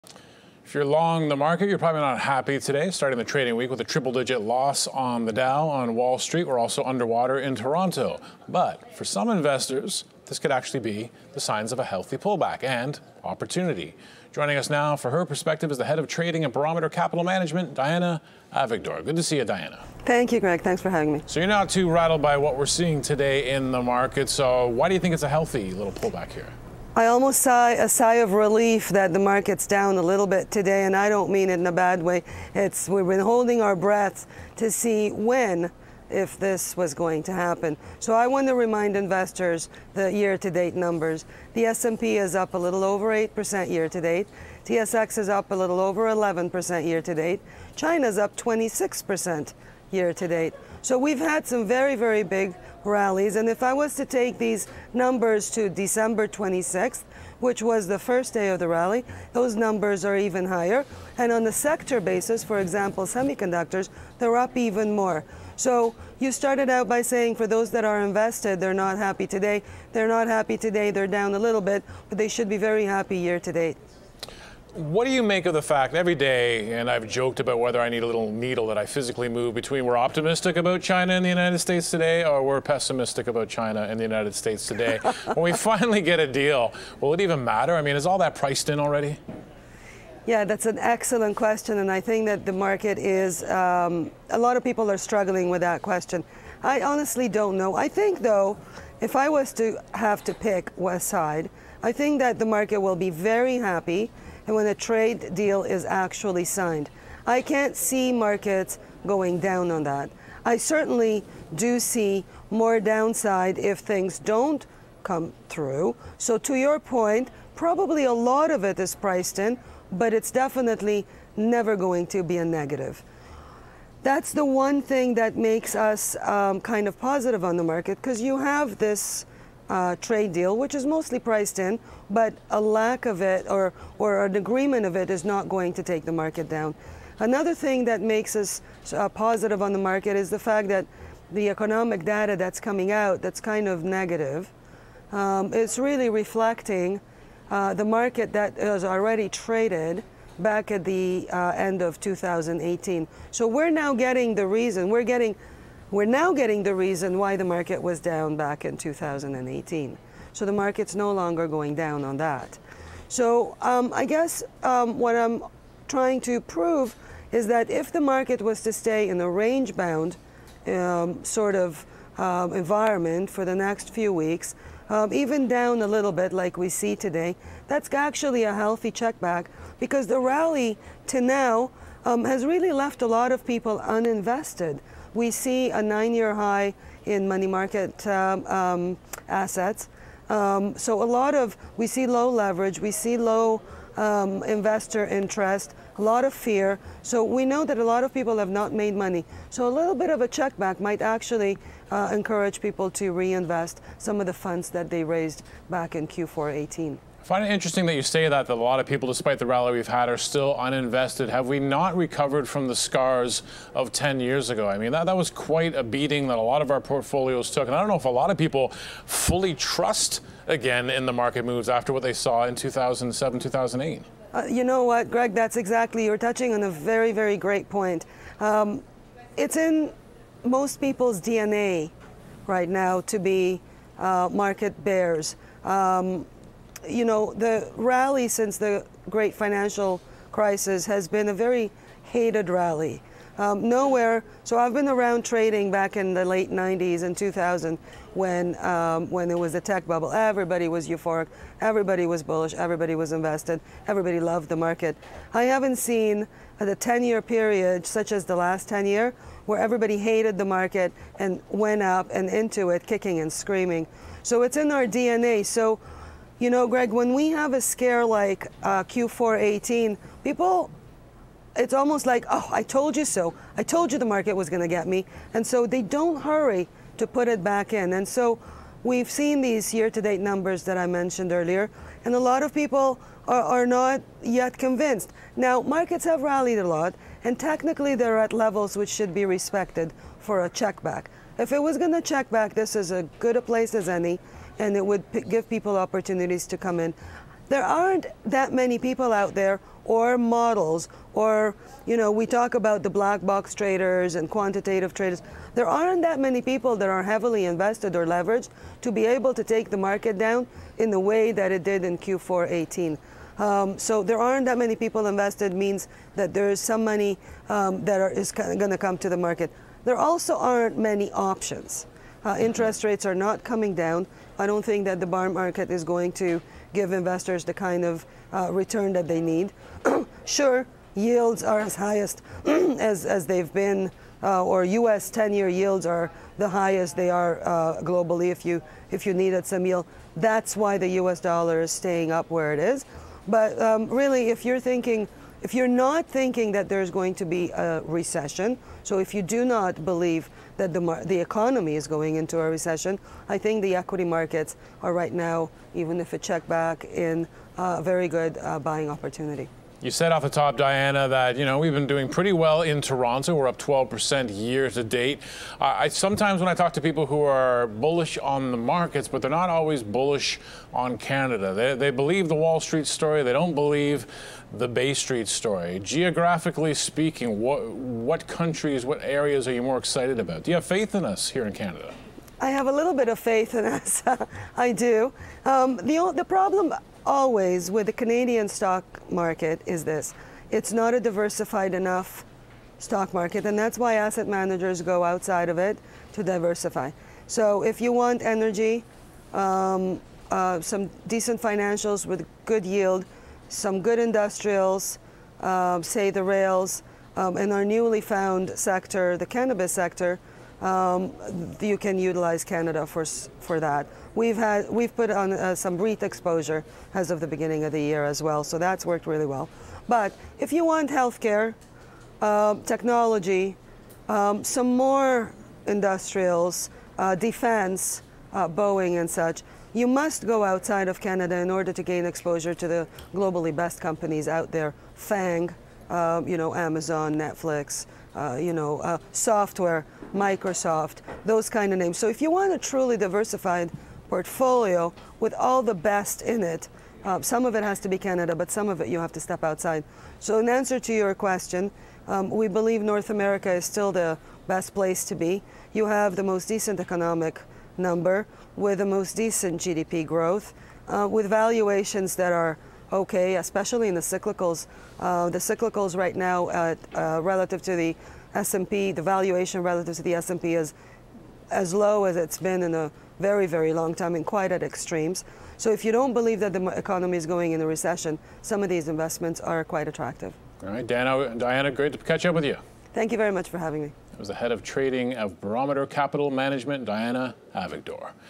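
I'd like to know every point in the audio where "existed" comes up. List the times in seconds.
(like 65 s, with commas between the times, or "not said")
not said.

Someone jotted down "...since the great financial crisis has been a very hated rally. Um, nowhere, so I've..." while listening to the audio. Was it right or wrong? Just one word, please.
right.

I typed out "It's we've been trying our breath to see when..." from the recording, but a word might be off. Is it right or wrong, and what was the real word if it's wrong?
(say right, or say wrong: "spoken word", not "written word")
wrong: "holding", not "trying".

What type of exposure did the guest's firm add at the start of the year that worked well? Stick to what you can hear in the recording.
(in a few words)
REIT.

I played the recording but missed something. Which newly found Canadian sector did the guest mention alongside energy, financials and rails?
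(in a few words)
cannabis.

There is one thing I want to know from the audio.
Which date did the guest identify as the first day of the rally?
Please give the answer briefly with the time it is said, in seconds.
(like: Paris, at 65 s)
December 26th, at 55 s.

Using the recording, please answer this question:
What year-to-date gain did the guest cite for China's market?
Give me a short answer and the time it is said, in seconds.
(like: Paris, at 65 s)
26%, at 48 s.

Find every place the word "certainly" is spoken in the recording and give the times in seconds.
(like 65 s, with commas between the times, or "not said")
110 s.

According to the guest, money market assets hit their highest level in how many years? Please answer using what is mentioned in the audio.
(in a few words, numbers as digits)
9.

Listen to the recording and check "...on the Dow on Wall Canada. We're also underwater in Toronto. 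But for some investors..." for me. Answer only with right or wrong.
wrong.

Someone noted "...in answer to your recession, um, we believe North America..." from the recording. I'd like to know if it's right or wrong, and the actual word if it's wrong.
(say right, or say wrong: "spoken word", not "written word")
wrong: "question", not "recession".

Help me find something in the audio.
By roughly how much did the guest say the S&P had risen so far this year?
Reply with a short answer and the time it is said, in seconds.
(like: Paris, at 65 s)
a little over 8%, at 42 s.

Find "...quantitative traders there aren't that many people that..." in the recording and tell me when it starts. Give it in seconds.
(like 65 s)
304 s.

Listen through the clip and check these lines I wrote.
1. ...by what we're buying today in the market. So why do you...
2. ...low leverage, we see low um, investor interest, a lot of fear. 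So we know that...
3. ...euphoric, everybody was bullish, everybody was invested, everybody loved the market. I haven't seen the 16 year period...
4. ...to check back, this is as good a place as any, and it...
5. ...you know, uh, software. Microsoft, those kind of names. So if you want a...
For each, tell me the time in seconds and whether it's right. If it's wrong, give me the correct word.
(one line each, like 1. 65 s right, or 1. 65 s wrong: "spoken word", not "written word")
1. 22 s wrong: "seeing", not "buying"
2. 192 s right
3. 250 s wrong: "10", not "16"
4. 291 s right
5. 438 s right.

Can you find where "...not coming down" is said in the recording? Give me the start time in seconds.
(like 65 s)
323 s.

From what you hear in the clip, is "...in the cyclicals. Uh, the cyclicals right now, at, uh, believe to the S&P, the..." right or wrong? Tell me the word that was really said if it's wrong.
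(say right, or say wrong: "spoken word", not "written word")
wrong: "relative", not "believe".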